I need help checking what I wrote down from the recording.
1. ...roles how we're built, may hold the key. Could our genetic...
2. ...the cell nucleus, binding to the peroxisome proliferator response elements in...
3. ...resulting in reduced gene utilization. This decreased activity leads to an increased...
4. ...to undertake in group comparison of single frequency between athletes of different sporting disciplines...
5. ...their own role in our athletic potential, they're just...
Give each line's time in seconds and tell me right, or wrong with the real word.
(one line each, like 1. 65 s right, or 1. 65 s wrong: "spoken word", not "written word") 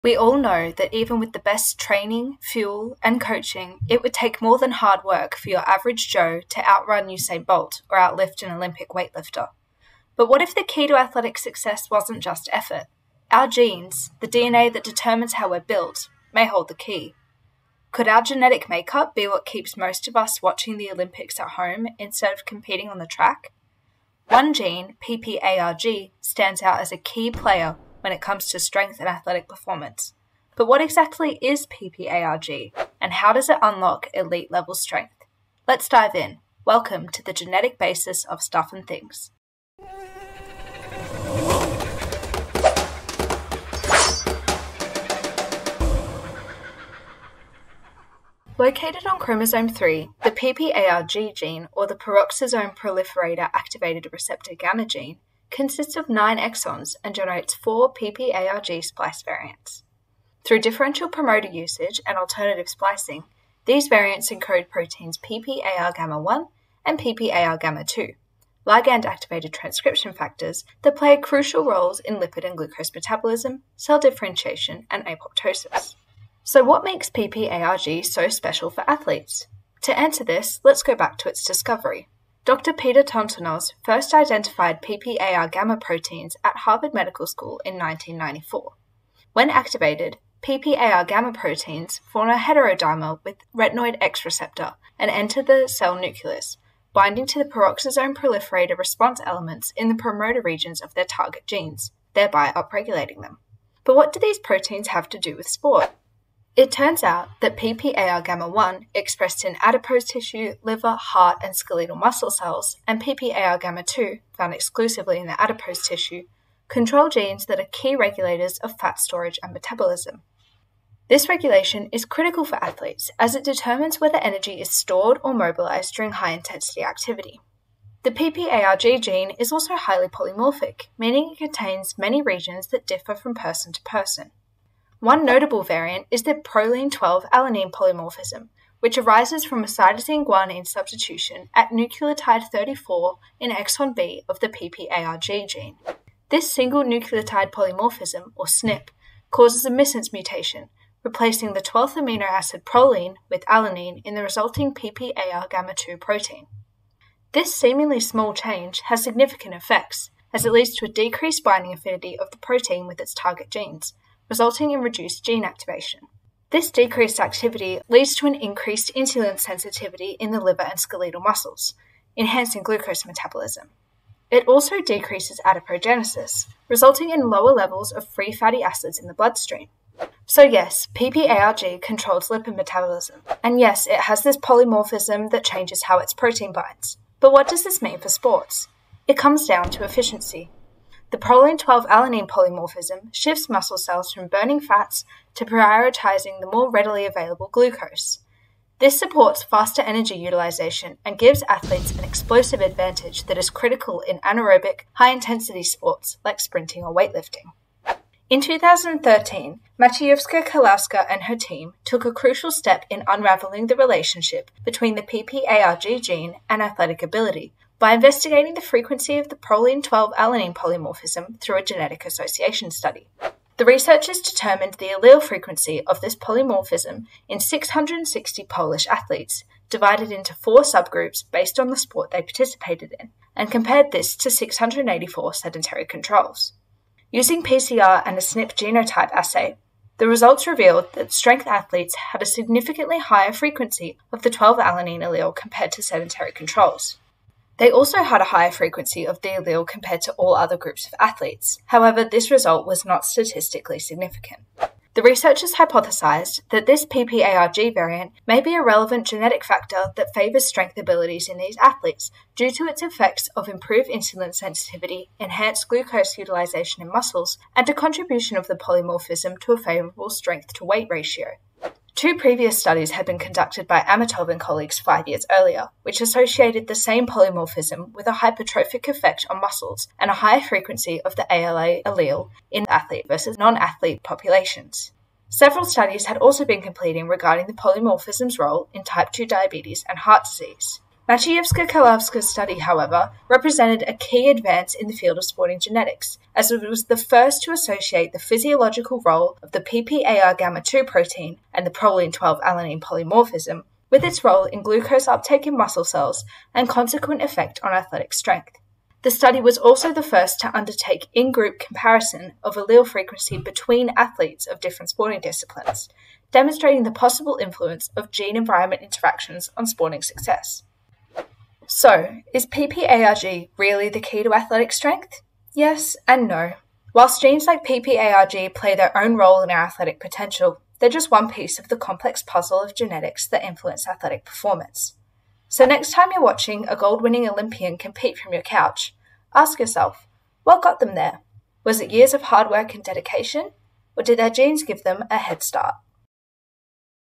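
1. 14 s wrong: "determines", not "roles"
2. 95 s right
3. 164 s wrong: "activation", not "utilization"
4. 310 s wrong: "allele", not "single"
5. 328 s right.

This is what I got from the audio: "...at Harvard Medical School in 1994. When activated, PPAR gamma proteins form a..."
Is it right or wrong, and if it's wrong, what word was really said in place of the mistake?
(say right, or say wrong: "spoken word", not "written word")
right.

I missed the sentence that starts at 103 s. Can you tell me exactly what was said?
But what do these proteins have to do with sport?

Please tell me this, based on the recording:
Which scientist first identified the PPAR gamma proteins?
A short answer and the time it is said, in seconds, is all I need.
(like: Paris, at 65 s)
Peter Tontonoz, at 82 s.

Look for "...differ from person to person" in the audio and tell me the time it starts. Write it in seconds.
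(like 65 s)
132 s.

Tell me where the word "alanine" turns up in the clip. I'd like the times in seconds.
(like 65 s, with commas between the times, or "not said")
136 s, 153 s, 191 s, 220 s, 244 s, 302 s.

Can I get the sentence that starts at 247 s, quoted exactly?
They also had a higher frequency of the allele compared to all other groups of athletes.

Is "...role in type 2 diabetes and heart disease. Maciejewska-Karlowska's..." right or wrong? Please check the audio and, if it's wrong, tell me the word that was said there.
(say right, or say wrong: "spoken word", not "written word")
right.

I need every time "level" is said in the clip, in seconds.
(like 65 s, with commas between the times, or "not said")
34 s, 177 s.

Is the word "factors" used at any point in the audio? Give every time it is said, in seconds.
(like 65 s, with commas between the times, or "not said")
70 s, 259 s.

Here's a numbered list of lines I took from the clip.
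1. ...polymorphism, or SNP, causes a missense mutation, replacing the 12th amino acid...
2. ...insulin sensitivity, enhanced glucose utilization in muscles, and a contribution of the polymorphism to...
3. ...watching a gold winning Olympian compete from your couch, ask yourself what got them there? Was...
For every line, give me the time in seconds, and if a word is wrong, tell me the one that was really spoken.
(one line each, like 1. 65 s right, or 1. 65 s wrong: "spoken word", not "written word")
1. 147 s right
2. 263 s right
3. 336 s right.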